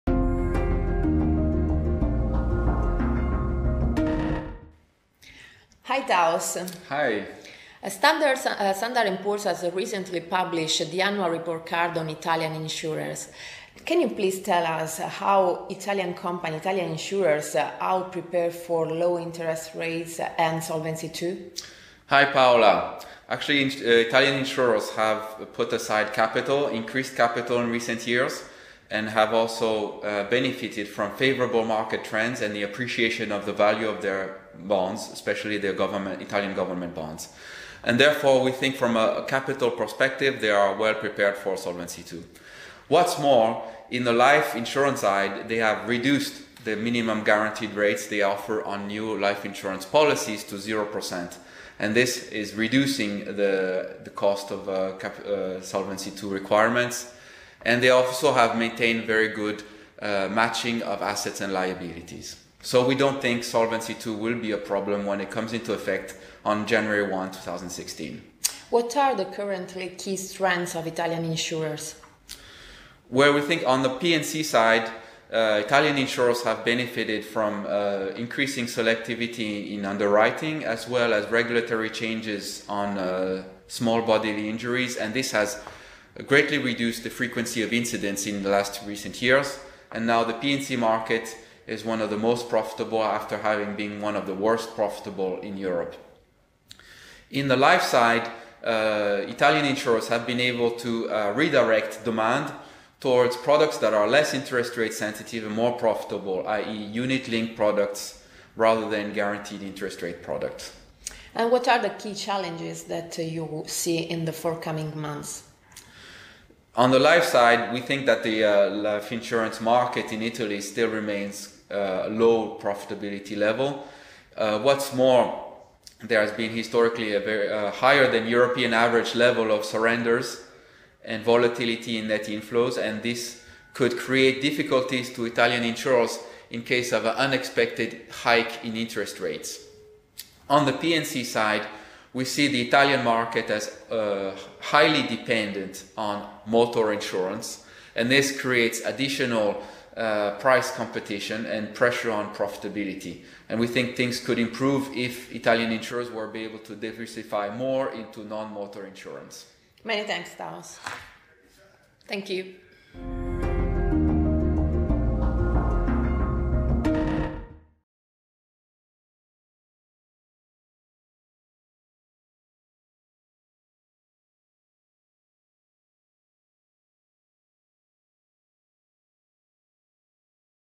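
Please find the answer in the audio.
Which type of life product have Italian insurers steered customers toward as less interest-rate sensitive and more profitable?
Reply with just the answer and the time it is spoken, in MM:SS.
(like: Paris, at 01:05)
Unit linked products, at 01:46.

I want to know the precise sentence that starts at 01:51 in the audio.
And what are the key challenges that you see in the forthcoming months?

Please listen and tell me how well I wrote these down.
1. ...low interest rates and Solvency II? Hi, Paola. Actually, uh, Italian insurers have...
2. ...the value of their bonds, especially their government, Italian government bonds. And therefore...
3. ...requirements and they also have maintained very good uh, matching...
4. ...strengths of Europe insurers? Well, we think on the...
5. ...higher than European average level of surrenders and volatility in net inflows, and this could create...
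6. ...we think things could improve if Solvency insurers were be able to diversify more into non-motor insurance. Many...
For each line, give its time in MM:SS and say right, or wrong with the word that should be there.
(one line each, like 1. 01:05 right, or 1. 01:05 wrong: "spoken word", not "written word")
1. 00:18 right
2. 00:33 right
3. 00:56 right
4. 01:10 wrong: "Italian", not "Europe"
5. 02:07 right
6. 02:33 wrong: "Italian", not "Solvency".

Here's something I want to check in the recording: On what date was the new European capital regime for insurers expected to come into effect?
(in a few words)
January 1, 2016.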